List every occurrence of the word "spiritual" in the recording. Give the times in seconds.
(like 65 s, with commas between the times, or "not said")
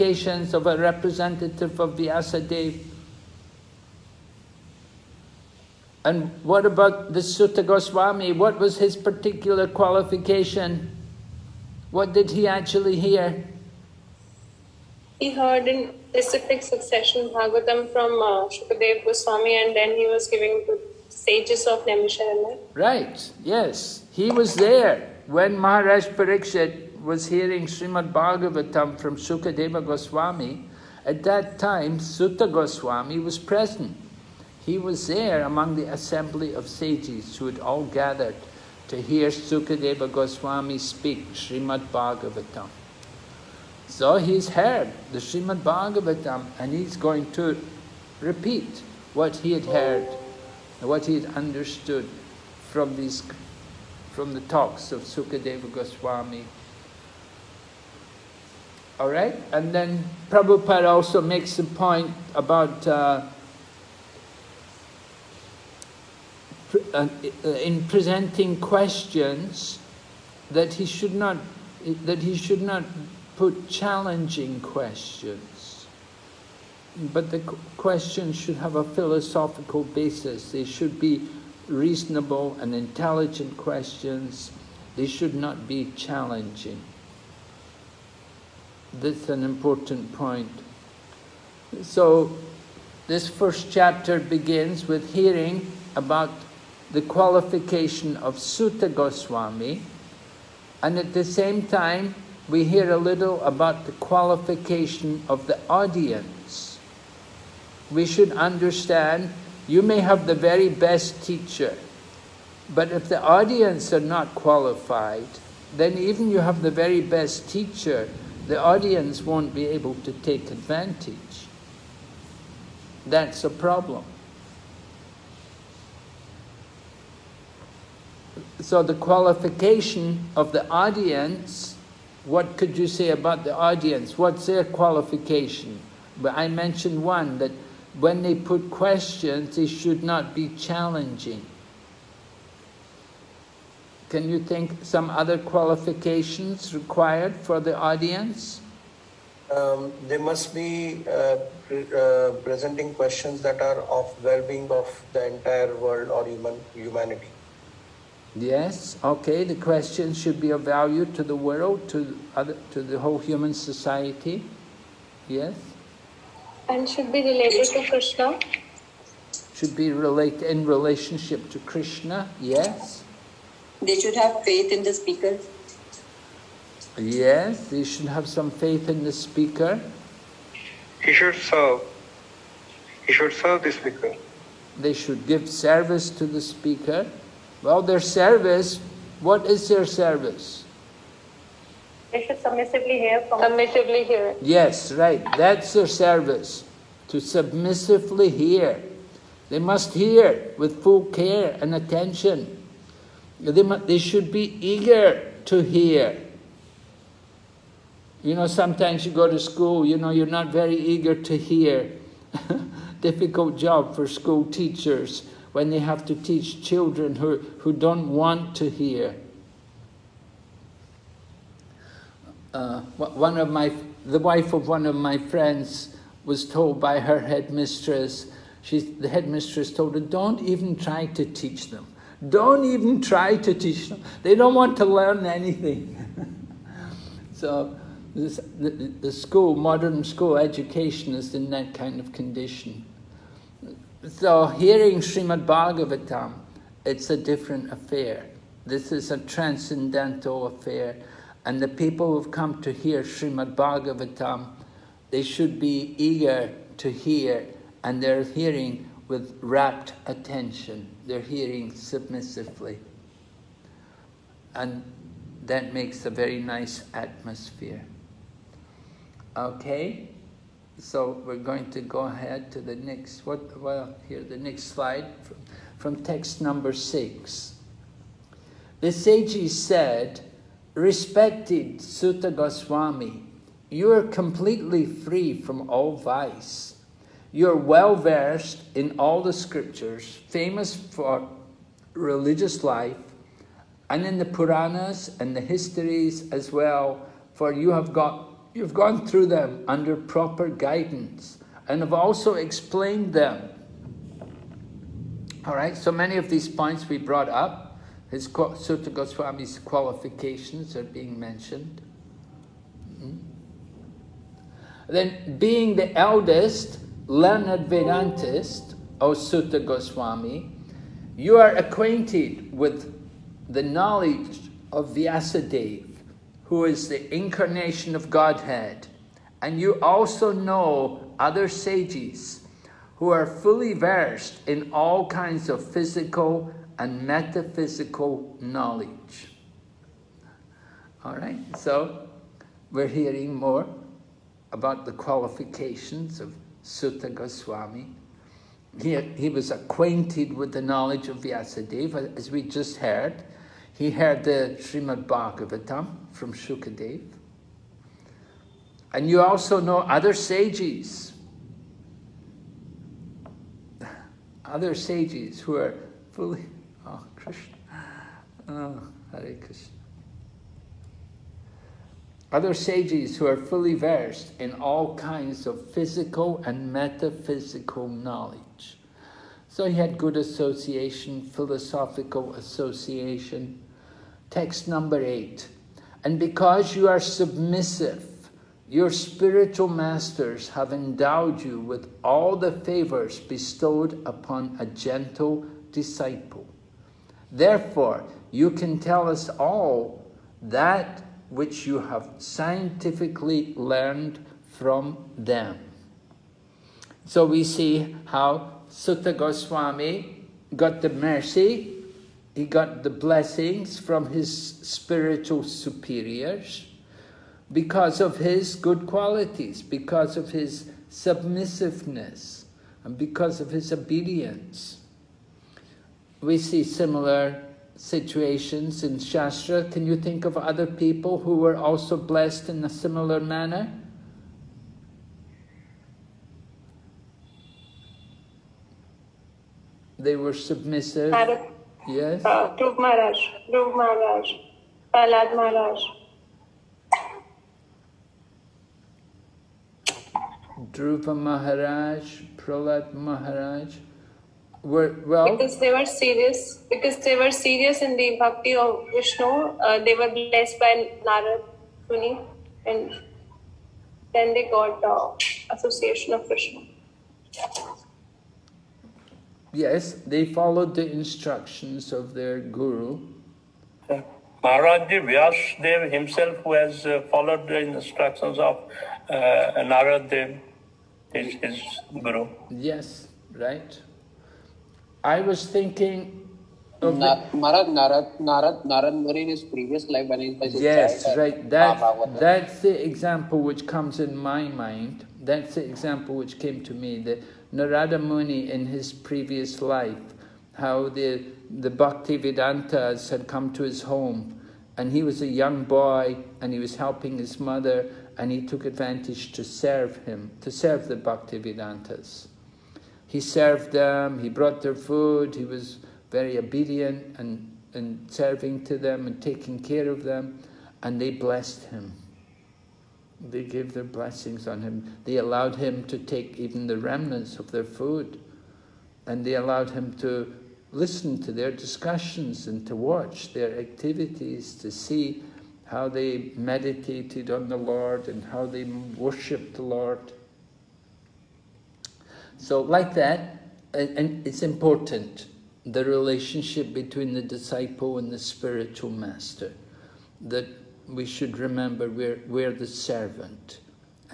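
388 s, 414 s, 548 s.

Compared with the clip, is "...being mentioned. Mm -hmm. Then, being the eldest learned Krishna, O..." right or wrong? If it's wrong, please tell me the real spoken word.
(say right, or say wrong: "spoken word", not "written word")
wrong: "Vedantist", not "Krishna".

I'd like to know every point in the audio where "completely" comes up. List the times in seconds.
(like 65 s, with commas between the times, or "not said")
284 s.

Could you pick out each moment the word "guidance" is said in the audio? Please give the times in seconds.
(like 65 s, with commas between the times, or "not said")
300 s.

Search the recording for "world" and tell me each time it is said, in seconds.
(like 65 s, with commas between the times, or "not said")
155 s, 161 s.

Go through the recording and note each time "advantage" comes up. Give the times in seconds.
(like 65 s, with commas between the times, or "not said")
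120 s, 508 s.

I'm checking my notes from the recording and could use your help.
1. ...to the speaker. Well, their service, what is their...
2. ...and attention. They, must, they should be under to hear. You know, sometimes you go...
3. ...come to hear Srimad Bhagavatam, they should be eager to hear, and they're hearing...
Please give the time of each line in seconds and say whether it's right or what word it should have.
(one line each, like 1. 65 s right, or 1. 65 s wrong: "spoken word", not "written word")
1. 186 s right
2. 201 s wrong: "eager", not "under"
3. 252 s right.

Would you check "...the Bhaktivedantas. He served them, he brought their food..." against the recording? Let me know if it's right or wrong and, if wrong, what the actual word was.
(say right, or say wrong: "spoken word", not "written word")
right.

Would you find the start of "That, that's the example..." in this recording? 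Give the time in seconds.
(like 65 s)
491 s.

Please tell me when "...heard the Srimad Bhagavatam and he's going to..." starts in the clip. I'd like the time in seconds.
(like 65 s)
44 s.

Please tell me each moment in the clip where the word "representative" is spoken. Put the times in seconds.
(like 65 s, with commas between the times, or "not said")
0 s.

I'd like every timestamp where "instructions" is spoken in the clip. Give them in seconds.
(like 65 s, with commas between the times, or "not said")
470 s, 477 s.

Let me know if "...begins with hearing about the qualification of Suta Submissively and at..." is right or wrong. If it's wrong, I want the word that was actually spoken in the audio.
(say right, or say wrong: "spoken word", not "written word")
wrong: "Goswami", not "Submissively".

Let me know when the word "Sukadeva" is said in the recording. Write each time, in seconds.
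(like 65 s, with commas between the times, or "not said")
29 s, 39 s, 55 s.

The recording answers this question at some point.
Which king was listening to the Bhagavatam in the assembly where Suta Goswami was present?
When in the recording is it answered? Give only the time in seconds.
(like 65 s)
25 s.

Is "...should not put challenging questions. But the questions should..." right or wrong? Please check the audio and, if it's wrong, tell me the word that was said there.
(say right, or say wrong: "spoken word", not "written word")
right.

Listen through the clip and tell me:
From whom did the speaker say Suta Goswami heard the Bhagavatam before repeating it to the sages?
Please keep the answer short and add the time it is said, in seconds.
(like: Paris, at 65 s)
Shukadev Goswami, at 18 s.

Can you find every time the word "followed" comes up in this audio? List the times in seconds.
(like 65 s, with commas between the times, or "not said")
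470 s, 477 s.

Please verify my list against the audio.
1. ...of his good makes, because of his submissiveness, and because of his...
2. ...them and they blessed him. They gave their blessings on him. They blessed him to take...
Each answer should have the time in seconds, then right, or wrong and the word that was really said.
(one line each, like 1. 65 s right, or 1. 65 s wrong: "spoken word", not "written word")
1. 417 s wrong: "qualities", not "makes"
2. 520 s wrong: "allowed", not "blessed".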